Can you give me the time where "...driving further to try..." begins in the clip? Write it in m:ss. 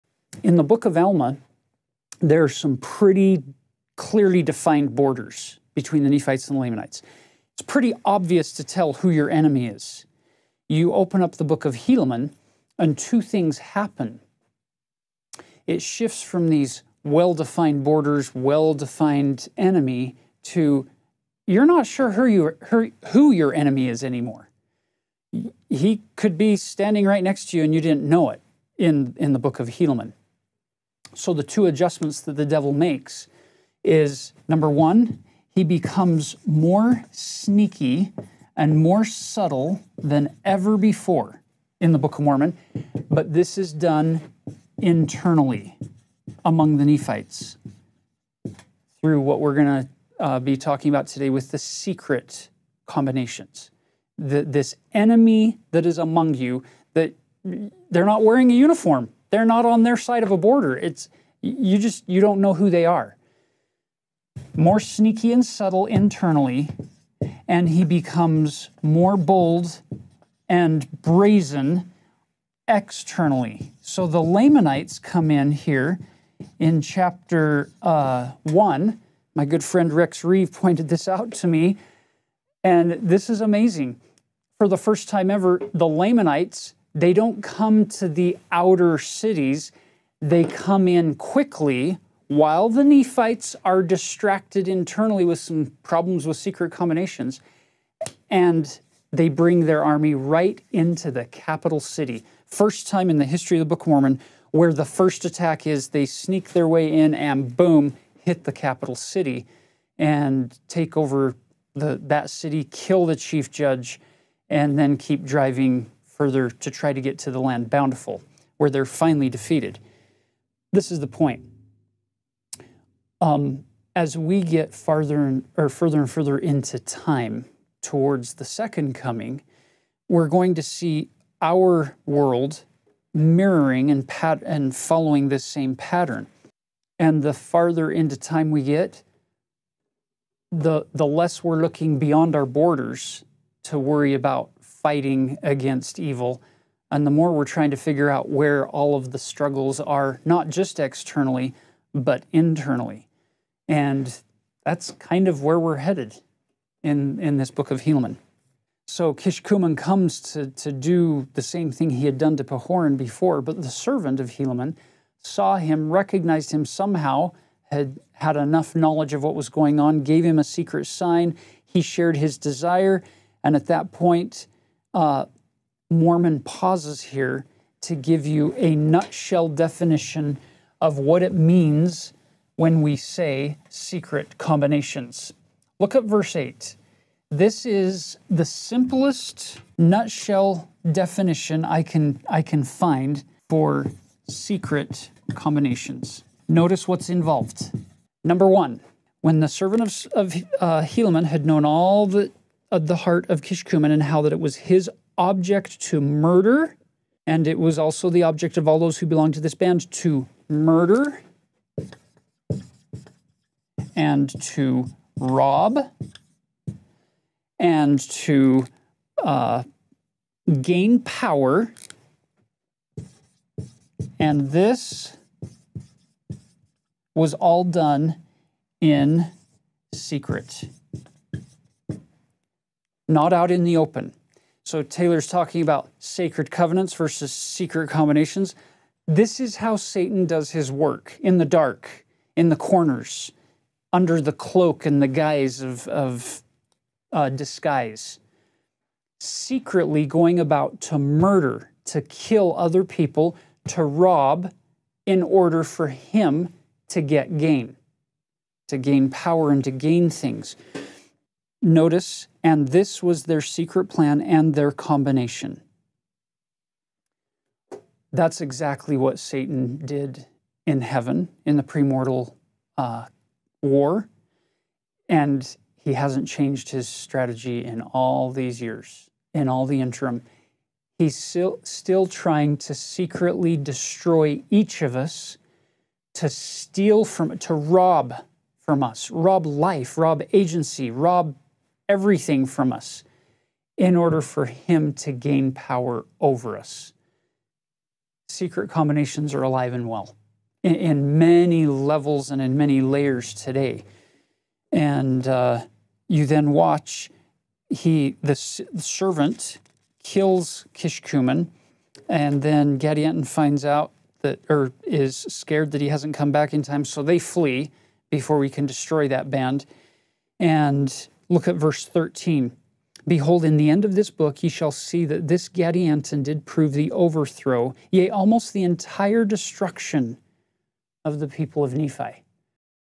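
1:55.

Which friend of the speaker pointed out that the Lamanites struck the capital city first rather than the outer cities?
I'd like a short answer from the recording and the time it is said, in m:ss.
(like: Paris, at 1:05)
Rex Reeve, at 1:19.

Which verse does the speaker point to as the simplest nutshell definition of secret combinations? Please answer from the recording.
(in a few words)
Verse 8.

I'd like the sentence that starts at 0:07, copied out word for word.
It's pretty obvious to tell who your enemy is.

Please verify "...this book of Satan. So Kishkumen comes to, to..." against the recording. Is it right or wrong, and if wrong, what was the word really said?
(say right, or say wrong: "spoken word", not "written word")
wrong: "Helaman", not "Satan".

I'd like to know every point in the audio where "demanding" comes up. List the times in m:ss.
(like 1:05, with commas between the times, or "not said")
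not said.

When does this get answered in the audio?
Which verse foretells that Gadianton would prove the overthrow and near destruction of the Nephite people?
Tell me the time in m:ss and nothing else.
5:21.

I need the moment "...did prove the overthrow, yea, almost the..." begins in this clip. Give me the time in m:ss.
5:26.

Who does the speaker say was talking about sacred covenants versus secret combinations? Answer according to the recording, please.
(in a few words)
Taylor.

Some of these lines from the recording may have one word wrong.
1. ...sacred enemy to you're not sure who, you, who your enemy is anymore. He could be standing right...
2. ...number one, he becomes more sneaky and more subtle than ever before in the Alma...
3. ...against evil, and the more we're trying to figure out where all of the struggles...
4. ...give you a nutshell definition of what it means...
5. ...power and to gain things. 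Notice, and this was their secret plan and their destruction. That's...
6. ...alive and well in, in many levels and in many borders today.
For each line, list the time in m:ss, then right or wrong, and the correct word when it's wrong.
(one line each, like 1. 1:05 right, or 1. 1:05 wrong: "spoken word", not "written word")
1. 0:18 wrong: "defined", not "sacred"
2. 0:34 wrong: "Book", not "Alma"
3. 2:25 right
4. 2:57 right
5. 4:19 wrong: "combination", not "destruction"
6. 4:59 wrong: "layers", not "borders".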